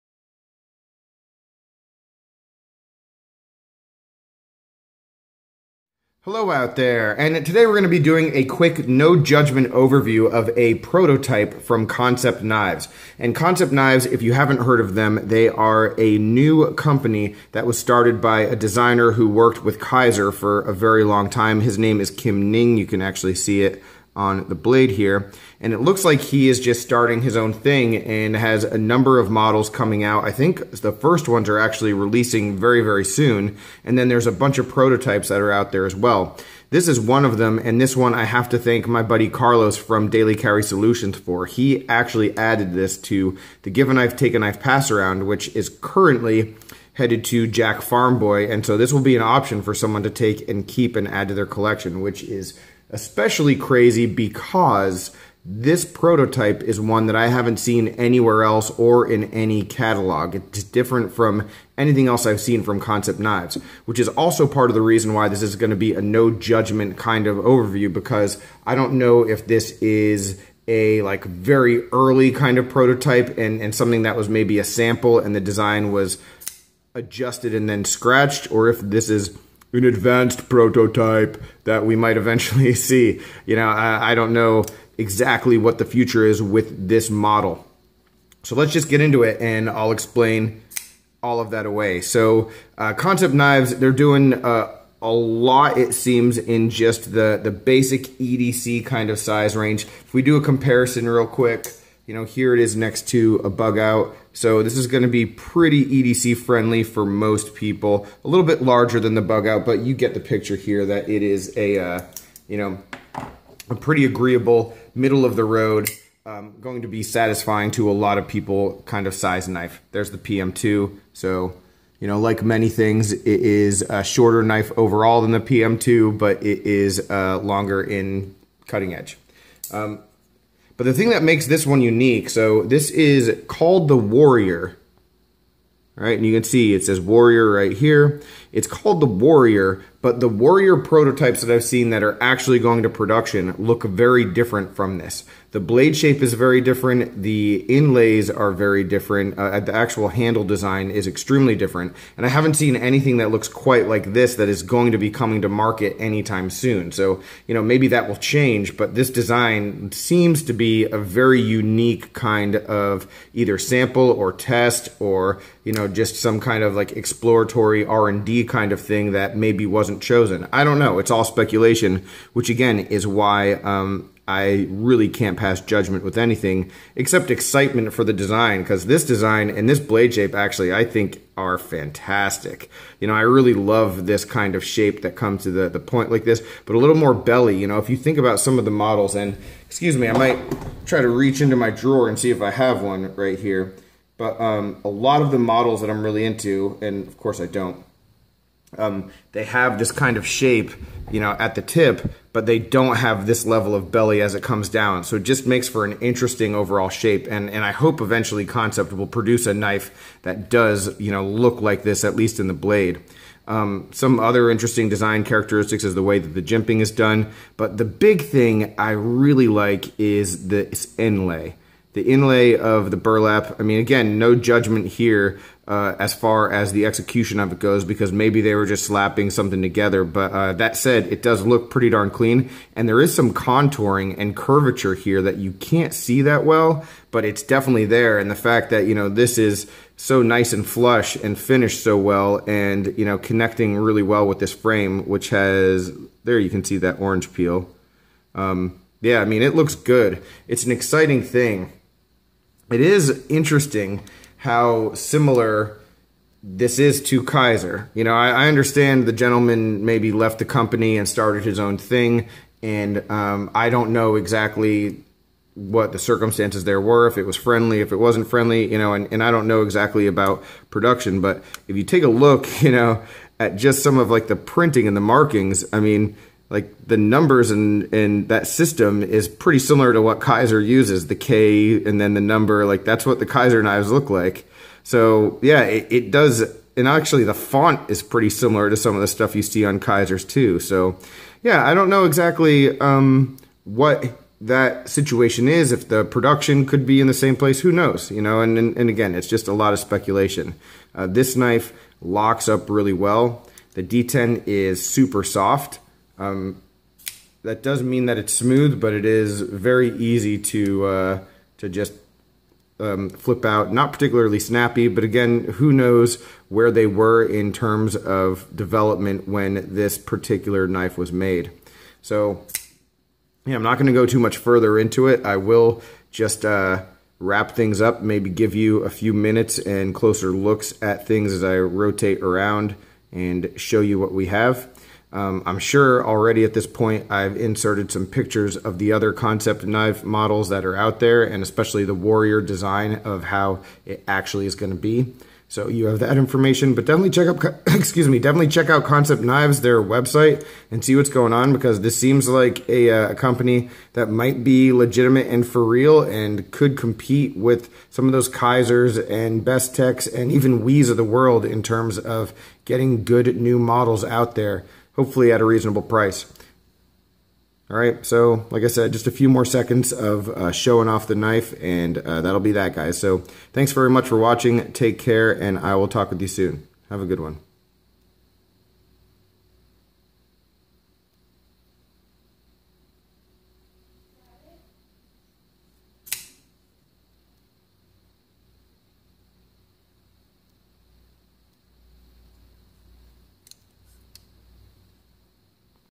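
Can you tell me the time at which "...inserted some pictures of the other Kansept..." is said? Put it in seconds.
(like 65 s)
337 s.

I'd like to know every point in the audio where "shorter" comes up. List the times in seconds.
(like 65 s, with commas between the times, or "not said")
124 s.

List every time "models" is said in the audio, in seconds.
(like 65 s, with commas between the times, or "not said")
29 s, 87 s, 188 s, 195 s, 340 s, 363 s.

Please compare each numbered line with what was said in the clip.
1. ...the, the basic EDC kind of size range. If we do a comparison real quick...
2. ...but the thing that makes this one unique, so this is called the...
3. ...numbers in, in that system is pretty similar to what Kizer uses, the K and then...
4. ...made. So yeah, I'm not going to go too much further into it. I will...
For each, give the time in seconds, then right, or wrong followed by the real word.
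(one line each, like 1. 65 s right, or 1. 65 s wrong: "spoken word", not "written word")
1. 97 s right
2. 130 s right
3. 276 s right
4. 321 s right.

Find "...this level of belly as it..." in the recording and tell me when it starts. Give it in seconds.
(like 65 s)
203 s.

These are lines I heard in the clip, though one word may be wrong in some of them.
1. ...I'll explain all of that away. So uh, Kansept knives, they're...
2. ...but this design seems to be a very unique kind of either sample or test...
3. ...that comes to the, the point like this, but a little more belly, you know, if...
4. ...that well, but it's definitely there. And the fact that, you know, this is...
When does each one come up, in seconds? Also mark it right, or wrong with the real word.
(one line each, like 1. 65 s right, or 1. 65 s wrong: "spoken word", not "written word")
1. 89 s right
2. 158 s right
3. 185 s right
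4. 236 s right.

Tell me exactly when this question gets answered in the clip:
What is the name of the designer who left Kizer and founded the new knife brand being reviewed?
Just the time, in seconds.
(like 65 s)
22 s.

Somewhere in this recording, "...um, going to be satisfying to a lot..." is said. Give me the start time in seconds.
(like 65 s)
116 s.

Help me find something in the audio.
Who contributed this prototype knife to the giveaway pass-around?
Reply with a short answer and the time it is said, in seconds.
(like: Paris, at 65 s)
Carlos, at 39 s.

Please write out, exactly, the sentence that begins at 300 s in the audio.
Uh, this knife locks up really well.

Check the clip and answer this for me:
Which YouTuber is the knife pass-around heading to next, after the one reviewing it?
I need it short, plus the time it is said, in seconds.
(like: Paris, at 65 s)
Jack Farm Boy, at 47 s.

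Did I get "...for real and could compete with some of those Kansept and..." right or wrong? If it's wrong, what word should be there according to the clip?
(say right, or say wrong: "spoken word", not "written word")
wrong: "Kizers", not "Kansept".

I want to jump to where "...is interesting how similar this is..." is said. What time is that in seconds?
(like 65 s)
252 s.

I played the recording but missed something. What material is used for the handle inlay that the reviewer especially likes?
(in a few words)
burlap.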